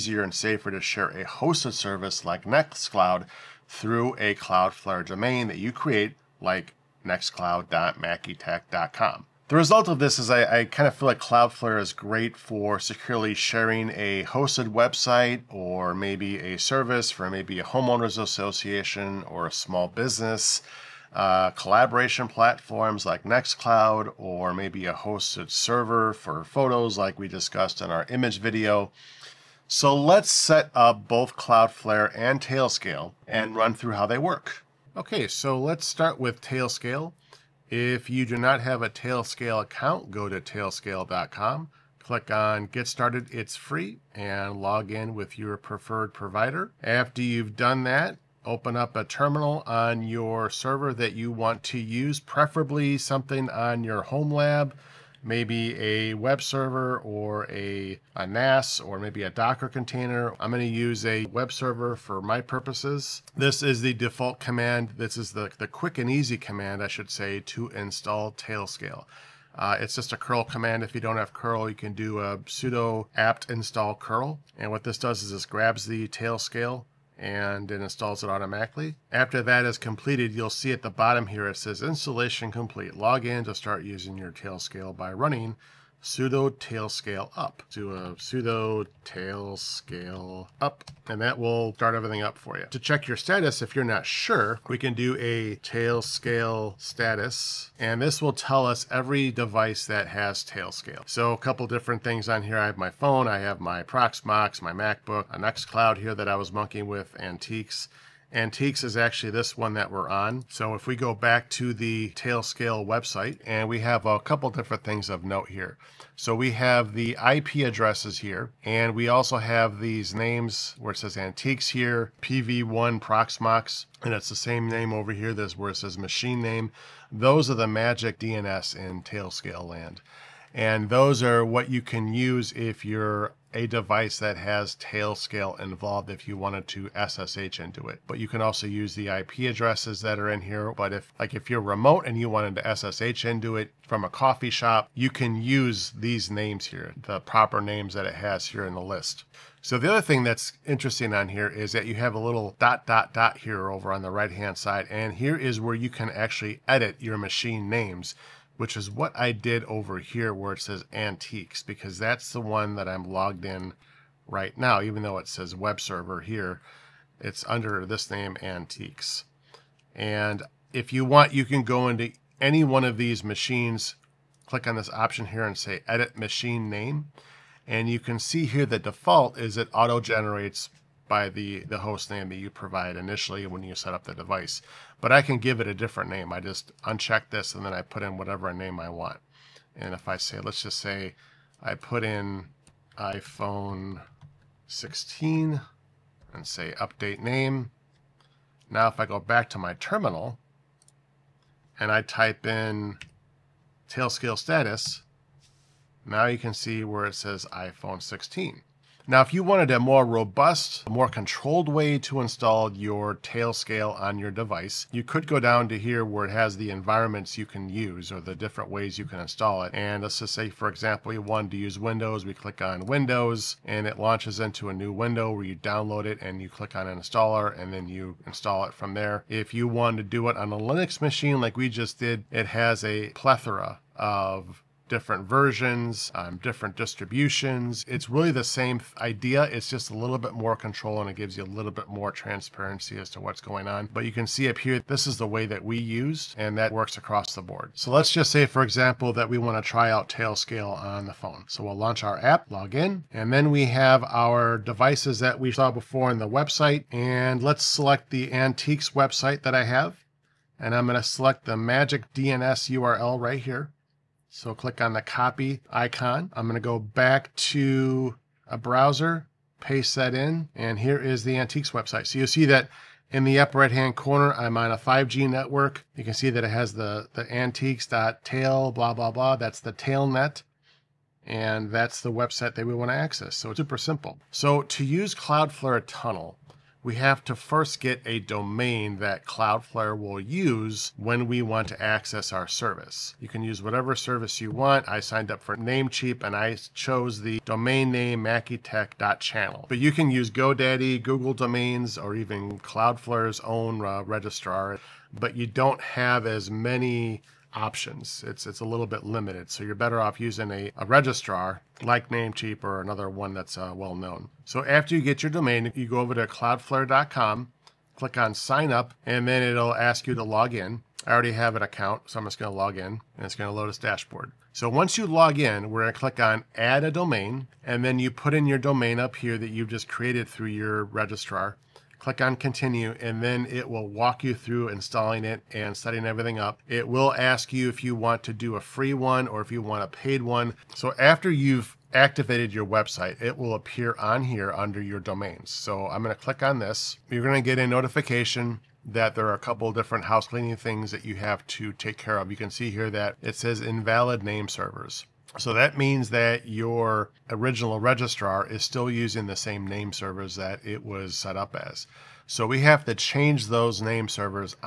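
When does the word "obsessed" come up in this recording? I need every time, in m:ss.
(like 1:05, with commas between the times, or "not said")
not said.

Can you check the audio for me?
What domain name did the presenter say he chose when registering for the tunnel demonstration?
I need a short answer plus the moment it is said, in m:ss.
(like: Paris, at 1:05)
mackeytech.channel, at 4:58.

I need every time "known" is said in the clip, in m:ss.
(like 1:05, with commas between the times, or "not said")
5:13.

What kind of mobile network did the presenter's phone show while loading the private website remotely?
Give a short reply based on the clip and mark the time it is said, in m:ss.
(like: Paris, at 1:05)
5G, at 4:34.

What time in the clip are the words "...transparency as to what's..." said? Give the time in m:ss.
4:02.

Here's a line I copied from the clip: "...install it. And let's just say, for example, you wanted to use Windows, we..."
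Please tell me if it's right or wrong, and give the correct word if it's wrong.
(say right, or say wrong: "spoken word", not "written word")
right.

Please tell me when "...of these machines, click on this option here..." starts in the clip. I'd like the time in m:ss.
2:52.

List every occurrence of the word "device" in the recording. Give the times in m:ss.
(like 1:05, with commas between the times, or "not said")
1:39, 2:13, 3:04, 3:34, 4:14.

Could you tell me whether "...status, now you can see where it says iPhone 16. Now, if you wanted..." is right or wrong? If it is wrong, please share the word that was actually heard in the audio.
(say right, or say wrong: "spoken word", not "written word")
right.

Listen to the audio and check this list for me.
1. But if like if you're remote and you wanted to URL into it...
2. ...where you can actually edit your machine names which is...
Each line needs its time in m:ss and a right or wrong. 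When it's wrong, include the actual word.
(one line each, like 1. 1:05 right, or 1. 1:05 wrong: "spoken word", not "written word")
1. 2:20 wrong: "SSH", not "URL"
2. 2:35 right.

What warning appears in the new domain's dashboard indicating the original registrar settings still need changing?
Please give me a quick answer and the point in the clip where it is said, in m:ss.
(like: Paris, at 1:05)
Invalid name servers, at 5:53.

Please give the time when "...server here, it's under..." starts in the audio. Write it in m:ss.
2:45.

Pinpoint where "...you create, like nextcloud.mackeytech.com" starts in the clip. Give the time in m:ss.
0:05.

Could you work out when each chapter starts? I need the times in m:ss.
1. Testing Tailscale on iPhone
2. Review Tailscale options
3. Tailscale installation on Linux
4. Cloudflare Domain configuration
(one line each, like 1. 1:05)
1. 4:08
2. 1:32
3. 0:35
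4. 5:07.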